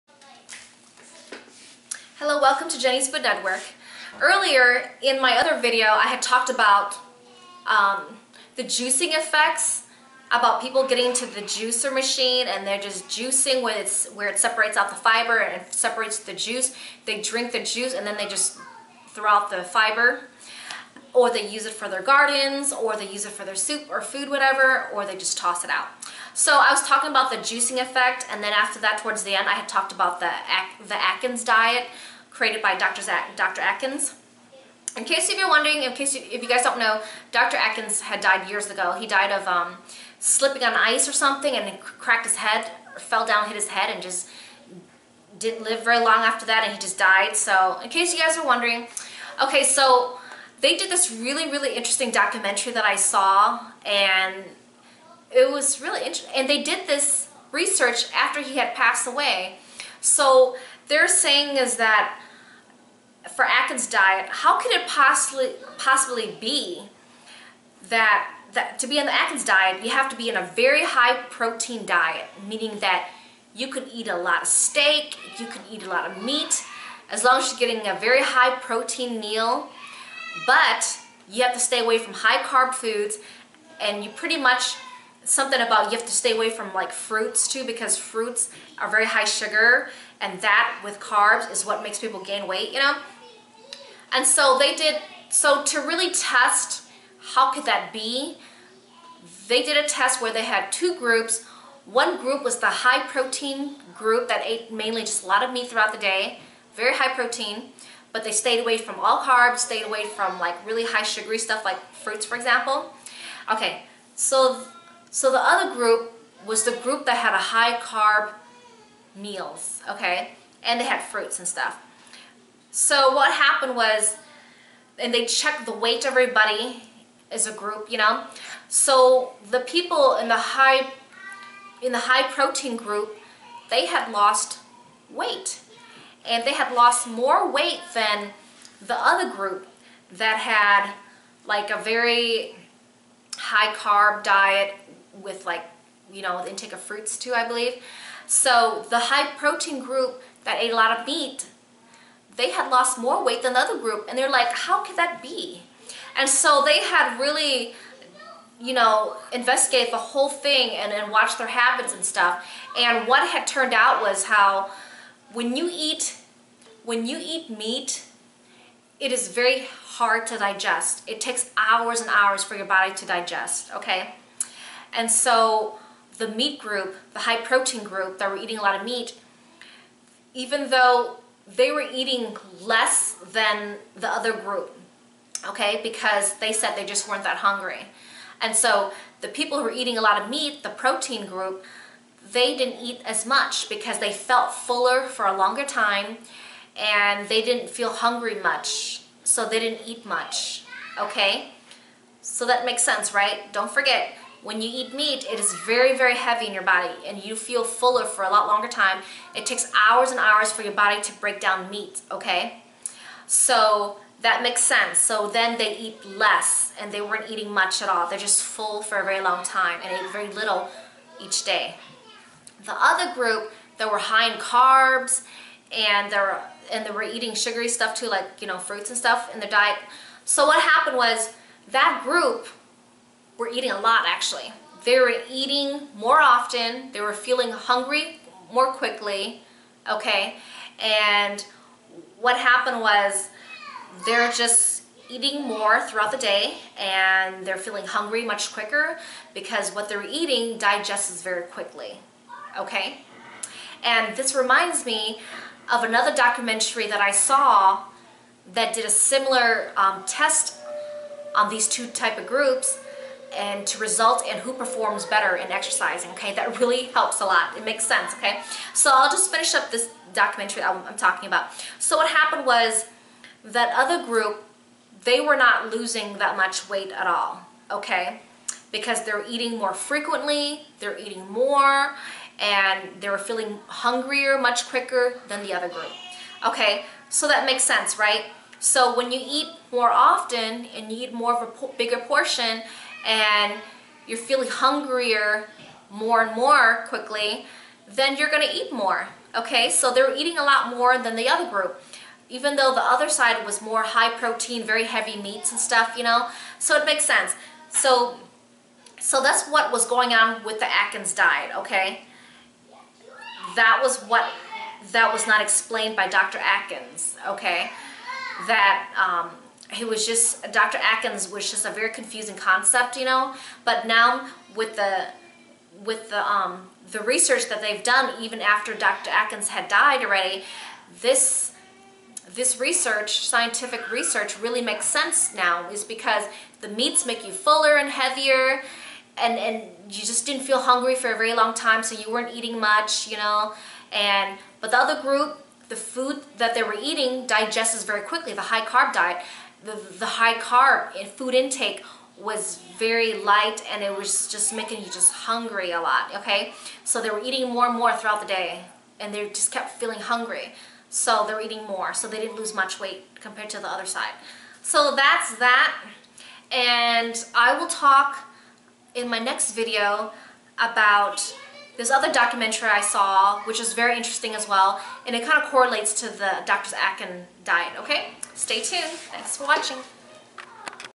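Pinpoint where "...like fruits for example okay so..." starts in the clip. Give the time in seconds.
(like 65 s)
111 s.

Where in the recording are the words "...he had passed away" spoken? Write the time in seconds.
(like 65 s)
58 s.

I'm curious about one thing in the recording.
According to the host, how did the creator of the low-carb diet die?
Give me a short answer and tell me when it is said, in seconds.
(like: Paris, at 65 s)
slipping on ice, at 40 s.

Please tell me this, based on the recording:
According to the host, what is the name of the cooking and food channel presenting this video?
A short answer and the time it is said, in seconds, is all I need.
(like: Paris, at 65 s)
Jenny's Food Network, at 2 s.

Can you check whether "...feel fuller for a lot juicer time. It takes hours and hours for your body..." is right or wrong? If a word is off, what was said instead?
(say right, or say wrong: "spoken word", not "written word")
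wrong: "longer", not "juicer".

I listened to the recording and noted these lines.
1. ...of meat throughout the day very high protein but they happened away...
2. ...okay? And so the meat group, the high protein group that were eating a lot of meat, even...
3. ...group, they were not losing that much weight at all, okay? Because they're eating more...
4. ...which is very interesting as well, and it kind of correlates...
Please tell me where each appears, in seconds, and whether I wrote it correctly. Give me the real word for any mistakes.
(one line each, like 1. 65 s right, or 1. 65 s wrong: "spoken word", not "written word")
1. 105 s wrong: "stayed", not "happened"
2. 173 s right
3. 274 s right
4. 373 s right.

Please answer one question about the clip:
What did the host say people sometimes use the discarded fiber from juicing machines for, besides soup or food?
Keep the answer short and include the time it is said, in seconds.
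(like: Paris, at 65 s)
their gardens, at 21 s.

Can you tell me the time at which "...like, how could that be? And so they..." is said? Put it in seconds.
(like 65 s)
154 s.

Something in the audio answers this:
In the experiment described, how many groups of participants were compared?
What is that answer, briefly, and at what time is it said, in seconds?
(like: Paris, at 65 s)
2, at 100 s.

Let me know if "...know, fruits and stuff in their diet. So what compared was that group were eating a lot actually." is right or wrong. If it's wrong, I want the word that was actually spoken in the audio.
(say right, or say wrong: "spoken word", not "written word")
wrong: "happened", not "compared".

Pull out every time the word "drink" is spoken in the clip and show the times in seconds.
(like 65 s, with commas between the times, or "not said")
17 s.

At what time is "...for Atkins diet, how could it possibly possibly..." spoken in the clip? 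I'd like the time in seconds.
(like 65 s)
63 s.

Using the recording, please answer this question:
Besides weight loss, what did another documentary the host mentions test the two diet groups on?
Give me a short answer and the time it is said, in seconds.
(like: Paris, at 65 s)
exercising, at 265 s.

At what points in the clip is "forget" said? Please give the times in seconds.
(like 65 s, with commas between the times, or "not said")
203 s.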